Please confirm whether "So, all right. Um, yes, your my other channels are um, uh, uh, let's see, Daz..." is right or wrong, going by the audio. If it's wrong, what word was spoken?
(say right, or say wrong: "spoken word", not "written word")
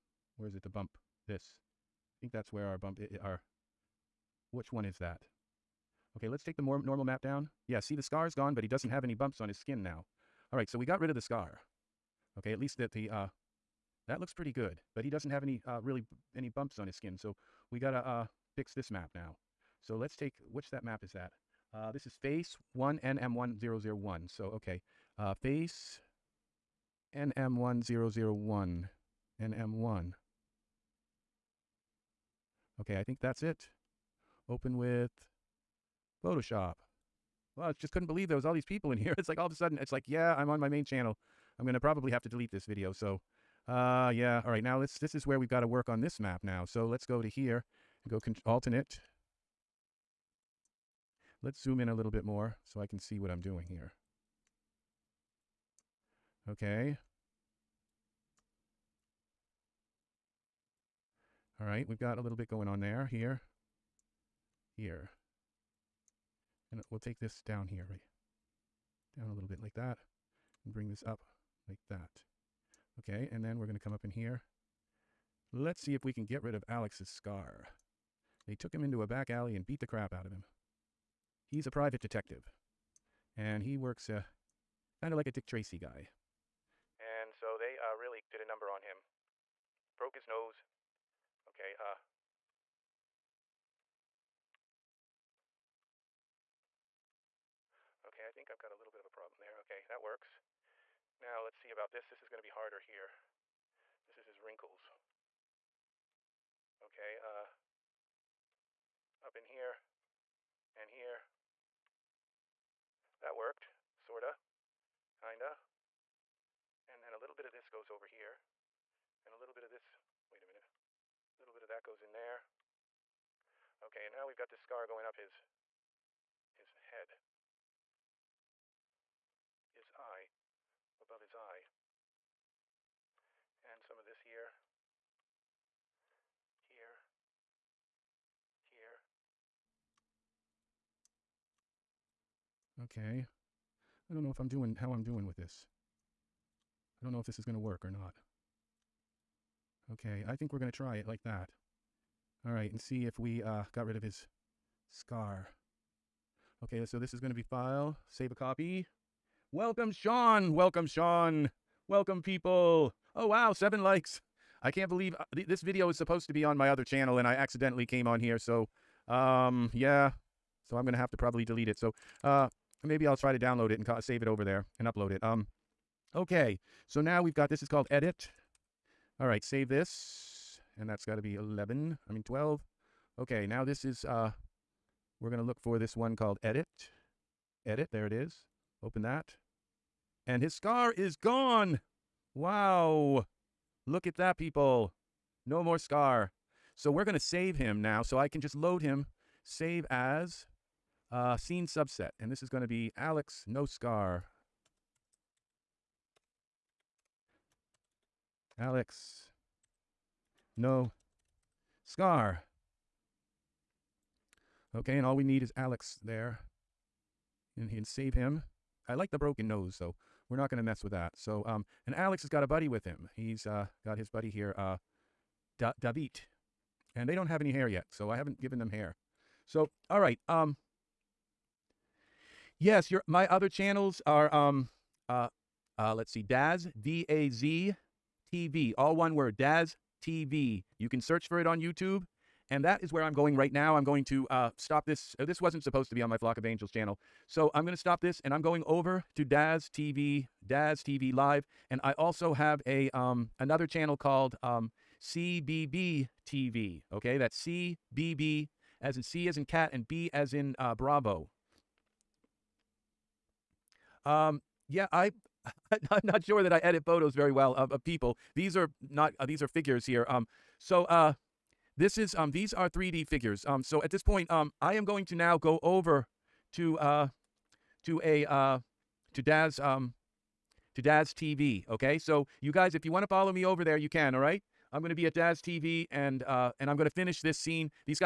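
right.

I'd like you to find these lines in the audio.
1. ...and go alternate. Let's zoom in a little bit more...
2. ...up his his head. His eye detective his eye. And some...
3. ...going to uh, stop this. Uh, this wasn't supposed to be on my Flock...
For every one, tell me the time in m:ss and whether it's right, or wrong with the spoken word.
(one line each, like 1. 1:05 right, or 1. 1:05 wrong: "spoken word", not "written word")
1. 0:48 right
2. 2:05 wrong: "above", not "detective"
3. 4:03 right.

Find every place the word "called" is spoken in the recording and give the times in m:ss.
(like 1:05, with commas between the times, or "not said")
2:57, 3:06, 4:13.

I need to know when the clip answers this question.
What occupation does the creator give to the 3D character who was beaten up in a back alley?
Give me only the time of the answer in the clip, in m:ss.
1:21.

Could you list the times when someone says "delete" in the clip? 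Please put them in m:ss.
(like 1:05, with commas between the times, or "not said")
0:42, 2:51.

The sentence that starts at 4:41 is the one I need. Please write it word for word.
Okay, so you guys, if you want to follow me over there, you can.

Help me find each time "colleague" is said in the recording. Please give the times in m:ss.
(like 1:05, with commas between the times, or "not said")
not said.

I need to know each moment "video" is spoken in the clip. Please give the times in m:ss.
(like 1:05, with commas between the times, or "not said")
0:42, 2:45.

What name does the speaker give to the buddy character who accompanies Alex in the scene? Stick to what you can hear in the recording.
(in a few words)
David.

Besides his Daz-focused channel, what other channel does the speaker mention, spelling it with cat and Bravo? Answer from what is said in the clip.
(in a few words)
CBB TV.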